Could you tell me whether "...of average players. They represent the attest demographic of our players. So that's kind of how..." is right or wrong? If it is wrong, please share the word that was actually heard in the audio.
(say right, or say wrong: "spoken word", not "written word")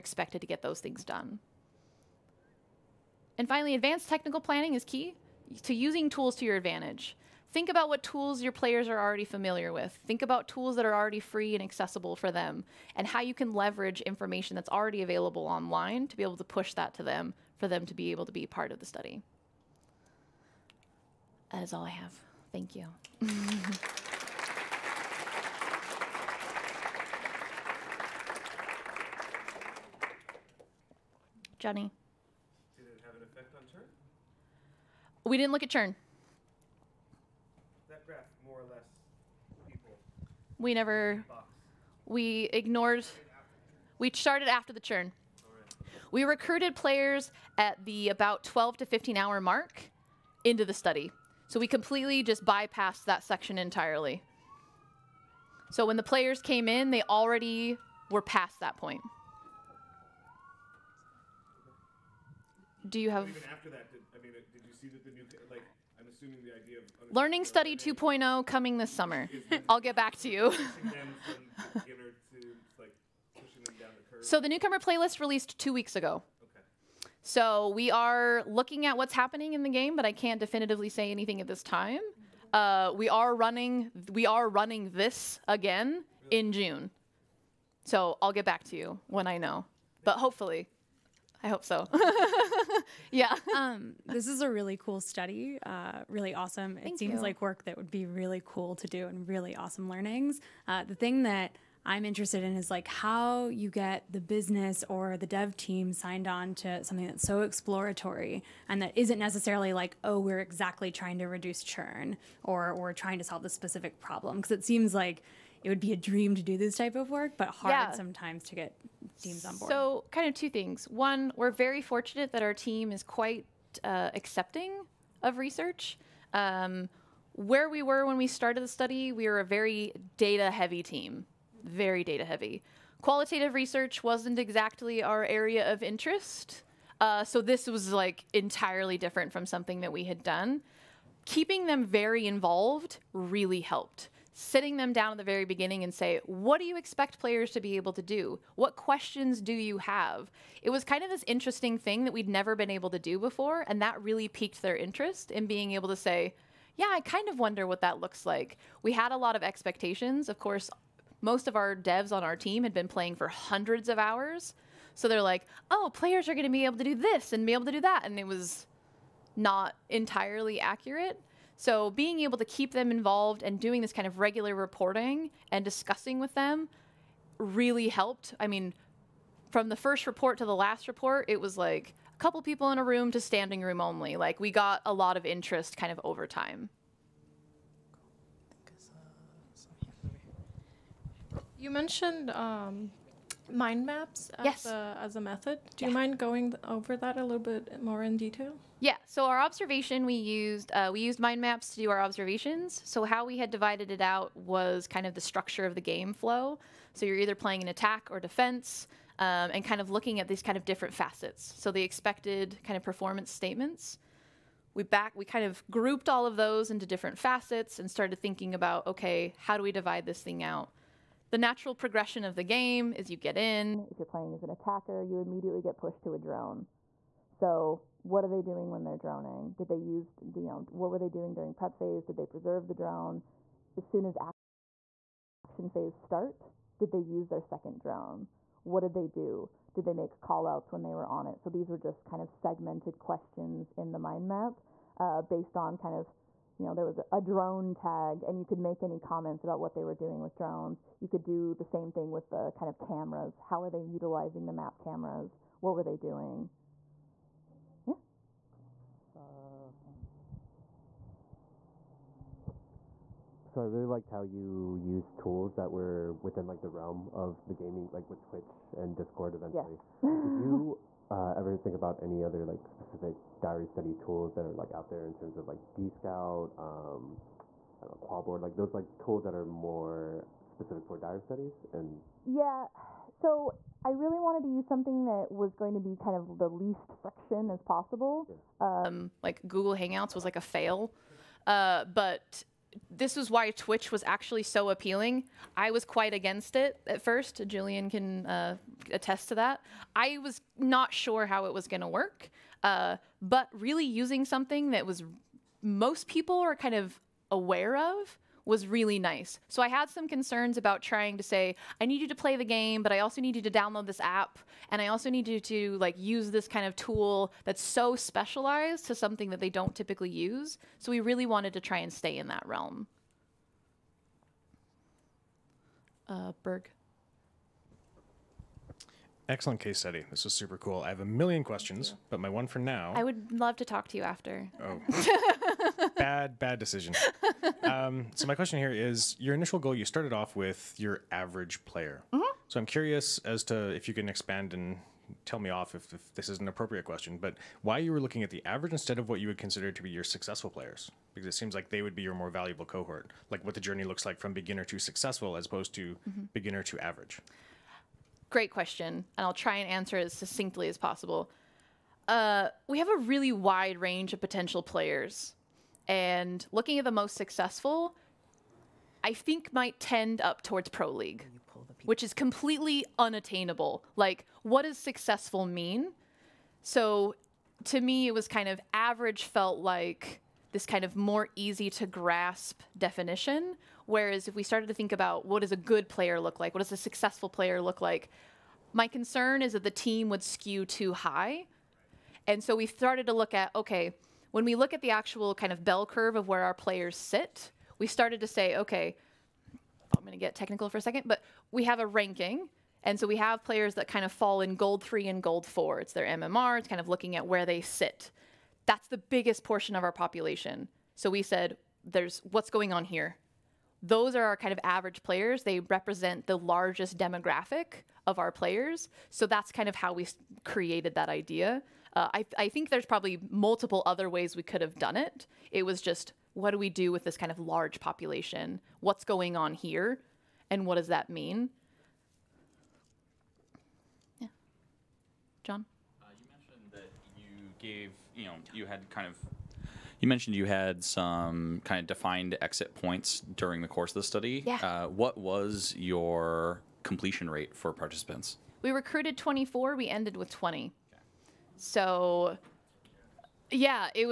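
wrong: "largest", not "attest".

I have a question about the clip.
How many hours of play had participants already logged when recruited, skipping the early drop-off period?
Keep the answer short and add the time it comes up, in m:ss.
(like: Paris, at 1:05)
12 to 15 hours, at 0:48.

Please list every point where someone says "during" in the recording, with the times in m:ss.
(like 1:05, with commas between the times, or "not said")
3:51, 7:23.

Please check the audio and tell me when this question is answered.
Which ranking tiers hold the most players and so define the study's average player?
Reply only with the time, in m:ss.
6:44.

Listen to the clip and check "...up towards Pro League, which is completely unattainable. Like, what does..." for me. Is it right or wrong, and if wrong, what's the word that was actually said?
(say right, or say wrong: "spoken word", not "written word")
right.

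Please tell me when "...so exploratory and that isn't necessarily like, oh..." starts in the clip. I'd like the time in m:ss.
1:47.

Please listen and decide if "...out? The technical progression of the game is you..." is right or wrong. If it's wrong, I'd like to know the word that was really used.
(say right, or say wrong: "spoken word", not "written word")
wrong: "natural", not "technical".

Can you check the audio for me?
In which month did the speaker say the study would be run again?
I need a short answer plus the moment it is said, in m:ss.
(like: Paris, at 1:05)
June, at 1:26.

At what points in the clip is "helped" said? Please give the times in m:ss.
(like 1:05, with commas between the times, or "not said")
2:23, 2:57.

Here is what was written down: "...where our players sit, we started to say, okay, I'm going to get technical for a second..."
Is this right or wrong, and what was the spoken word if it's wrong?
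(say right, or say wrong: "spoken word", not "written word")
right.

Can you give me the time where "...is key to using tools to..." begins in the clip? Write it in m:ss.
0:04.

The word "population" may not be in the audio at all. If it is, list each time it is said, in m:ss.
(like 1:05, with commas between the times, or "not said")
6:49, 7:07.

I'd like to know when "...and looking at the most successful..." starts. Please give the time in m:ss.
6:05.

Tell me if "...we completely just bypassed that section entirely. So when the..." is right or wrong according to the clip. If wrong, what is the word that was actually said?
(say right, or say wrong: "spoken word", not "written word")
right.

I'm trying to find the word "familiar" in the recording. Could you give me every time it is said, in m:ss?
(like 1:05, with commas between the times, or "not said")
0:09.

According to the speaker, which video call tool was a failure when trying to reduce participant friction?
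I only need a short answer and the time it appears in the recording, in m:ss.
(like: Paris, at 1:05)
Google Hangouts, at 4:49.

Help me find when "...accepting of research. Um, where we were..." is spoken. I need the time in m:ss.
2:04.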